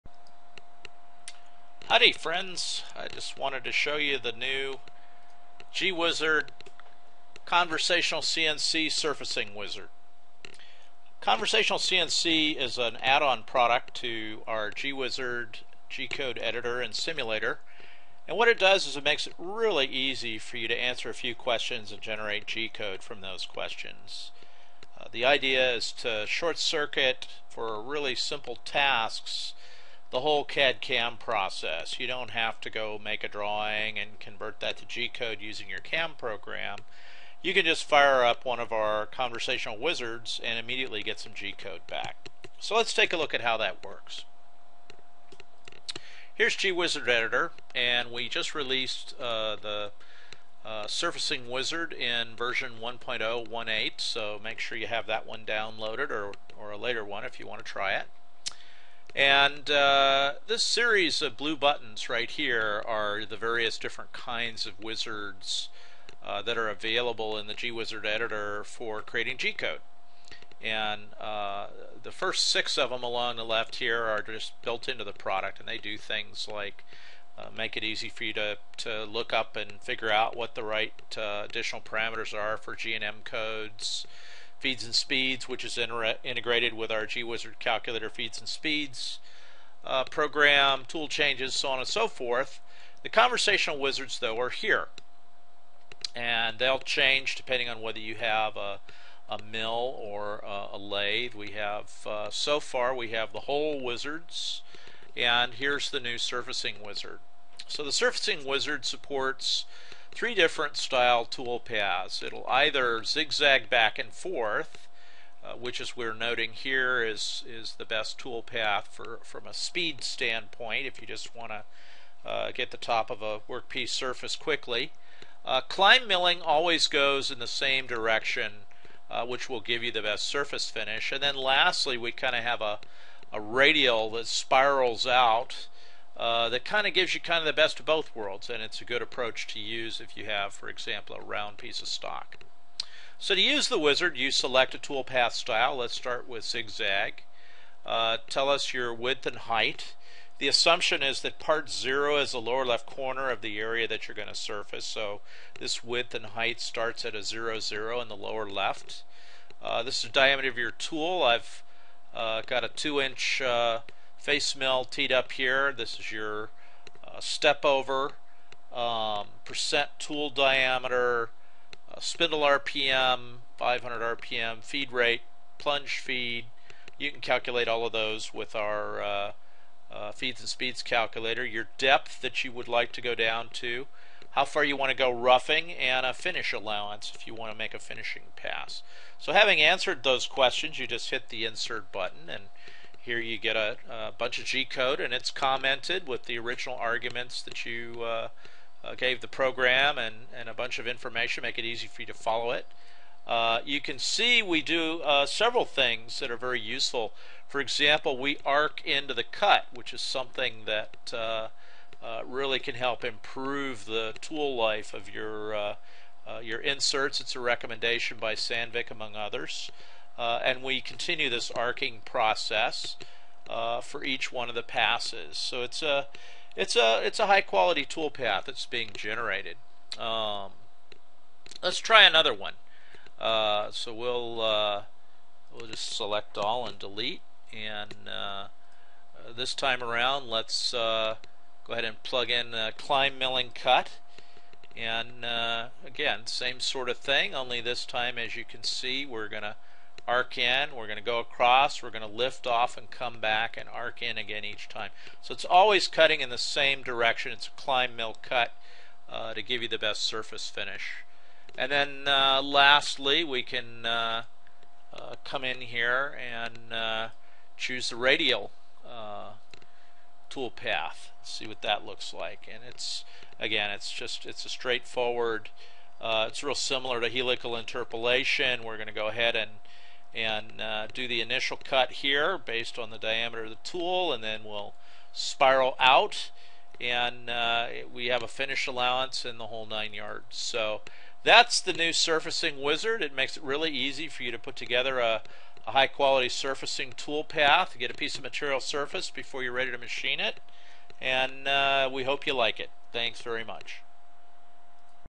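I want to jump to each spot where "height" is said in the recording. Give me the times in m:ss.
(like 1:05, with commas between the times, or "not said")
2:29, 2:36.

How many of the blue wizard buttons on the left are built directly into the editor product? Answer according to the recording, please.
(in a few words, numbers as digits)
6.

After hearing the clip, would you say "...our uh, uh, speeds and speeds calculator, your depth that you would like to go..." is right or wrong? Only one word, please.
wrong.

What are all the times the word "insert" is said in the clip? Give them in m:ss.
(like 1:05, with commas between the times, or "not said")
3:11, 3:36.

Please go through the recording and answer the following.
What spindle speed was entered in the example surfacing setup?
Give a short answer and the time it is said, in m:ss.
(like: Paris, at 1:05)
500 RPM, at 2:53.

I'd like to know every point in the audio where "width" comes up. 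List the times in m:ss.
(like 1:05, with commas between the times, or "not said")
2:28, 2:35.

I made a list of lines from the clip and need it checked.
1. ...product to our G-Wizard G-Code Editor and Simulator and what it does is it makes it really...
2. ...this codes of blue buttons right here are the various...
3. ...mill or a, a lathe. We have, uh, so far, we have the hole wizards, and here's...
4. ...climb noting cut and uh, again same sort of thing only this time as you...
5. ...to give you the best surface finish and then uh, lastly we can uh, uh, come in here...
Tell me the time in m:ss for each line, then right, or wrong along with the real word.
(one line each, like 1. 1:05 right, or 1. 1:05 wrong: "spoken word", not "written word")
1. 0:13 right
2. 1:00 wrong: "series", not "codes"
3. 1:39 right
4. 4:02 wrong: "milling", not "noting"
5. 4:19 right.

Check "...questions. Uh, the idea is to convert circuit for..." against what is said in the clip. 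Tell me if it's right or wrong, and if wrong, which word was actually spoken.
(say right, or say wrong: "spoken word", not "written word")
wrong: "short", not "convert".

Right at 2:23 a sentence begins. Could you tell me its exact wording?
So to use the wizard, you select a toolpath style.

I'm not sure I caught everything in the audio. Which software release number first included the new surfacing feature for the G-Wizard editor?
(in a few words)
1.0.18.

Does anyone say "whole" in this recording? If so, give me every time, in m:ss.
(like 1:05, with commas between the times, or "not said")
0:30, 4:49.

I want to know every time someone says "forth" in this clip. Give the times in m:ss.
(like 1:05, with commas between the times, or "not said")
1:32, 1:54.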